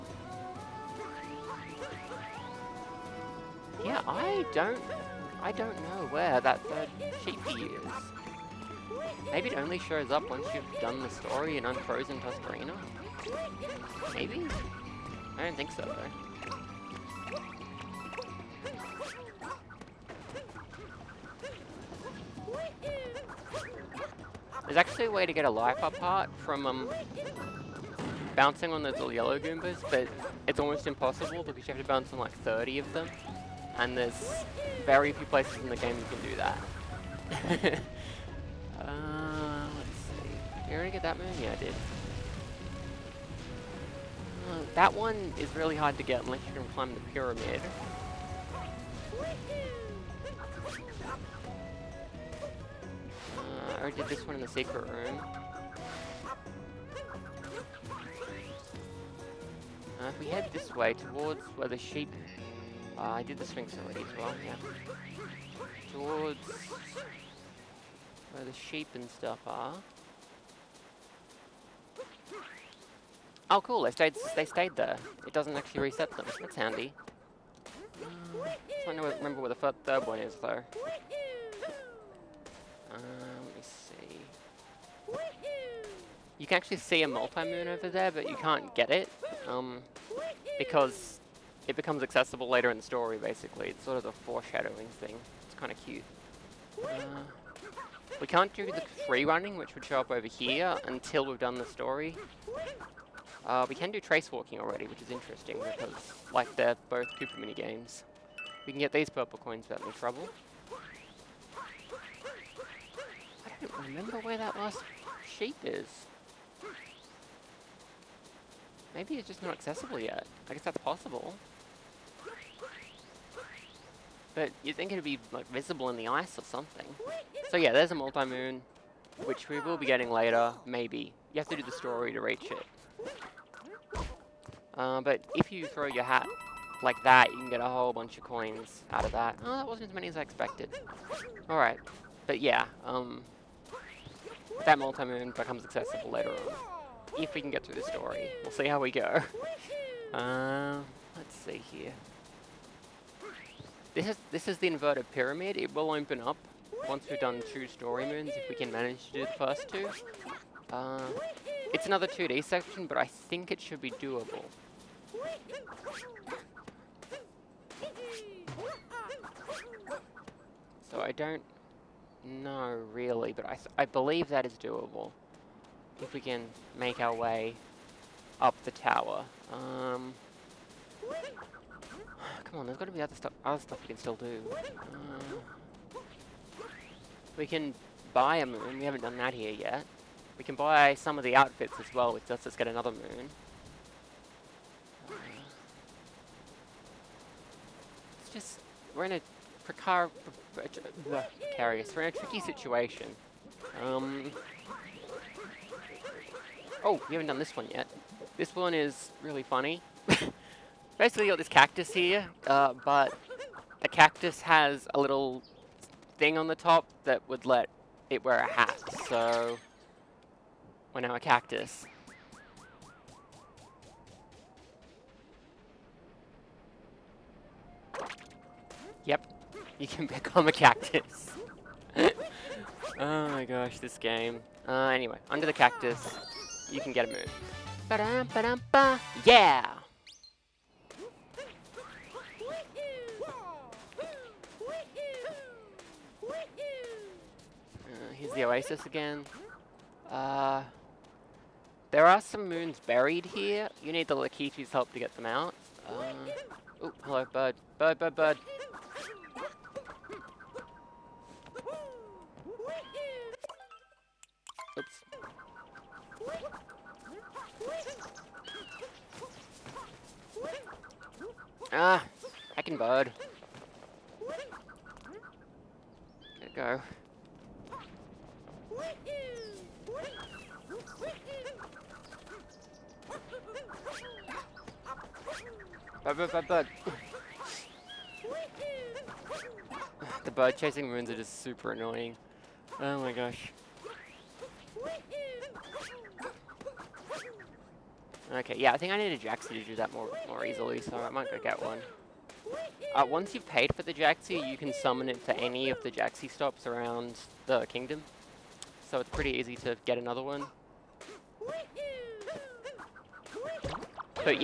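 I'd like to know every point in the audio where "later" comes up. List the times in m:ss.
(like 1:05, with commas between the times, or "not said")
1:32, 2:10, 2:26.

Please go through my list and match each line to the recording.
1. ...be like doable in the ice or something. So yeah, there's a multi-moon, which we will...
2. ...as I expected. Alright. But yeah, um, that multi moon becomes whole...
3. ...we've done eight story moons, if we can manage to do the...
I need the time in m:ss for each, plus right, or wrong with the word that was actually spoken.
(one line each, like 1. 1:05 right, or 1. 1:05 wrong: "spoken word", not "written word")
1. 2:05 wrong: "visible", not "doable"
2. 2:20 wrong: "accessible", not "whole"
3. 2:37 wrong: "two", not "eight".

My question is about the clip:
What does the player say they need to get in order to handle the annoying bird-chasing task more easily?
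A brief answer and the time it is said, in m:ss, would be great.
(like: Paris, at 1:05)
a Jaxi, at 4:59.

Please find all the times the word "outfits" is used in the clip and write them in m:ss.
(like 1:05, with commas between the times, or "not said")
3:11.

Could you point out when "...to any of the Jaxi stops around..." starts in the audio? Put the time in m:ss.
5:05.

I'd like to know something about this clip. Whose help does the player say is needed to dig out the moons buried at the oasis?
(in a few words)
Lakitu.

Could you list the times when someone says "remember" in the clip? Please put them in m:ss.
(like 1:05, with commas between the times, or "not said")
1:19, 1:53.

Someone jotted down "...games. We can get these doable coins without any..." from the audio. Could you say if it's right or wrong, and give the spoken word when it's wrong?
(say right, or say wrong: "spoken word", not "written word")
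wrong: "purple", not "doable".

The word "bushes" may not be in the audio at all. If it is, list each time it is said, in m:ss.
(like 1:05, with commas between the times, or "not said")
not said.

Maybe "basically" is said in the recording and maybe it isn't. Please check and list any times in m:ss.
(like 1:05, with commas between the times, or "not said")
1:33, 3:30.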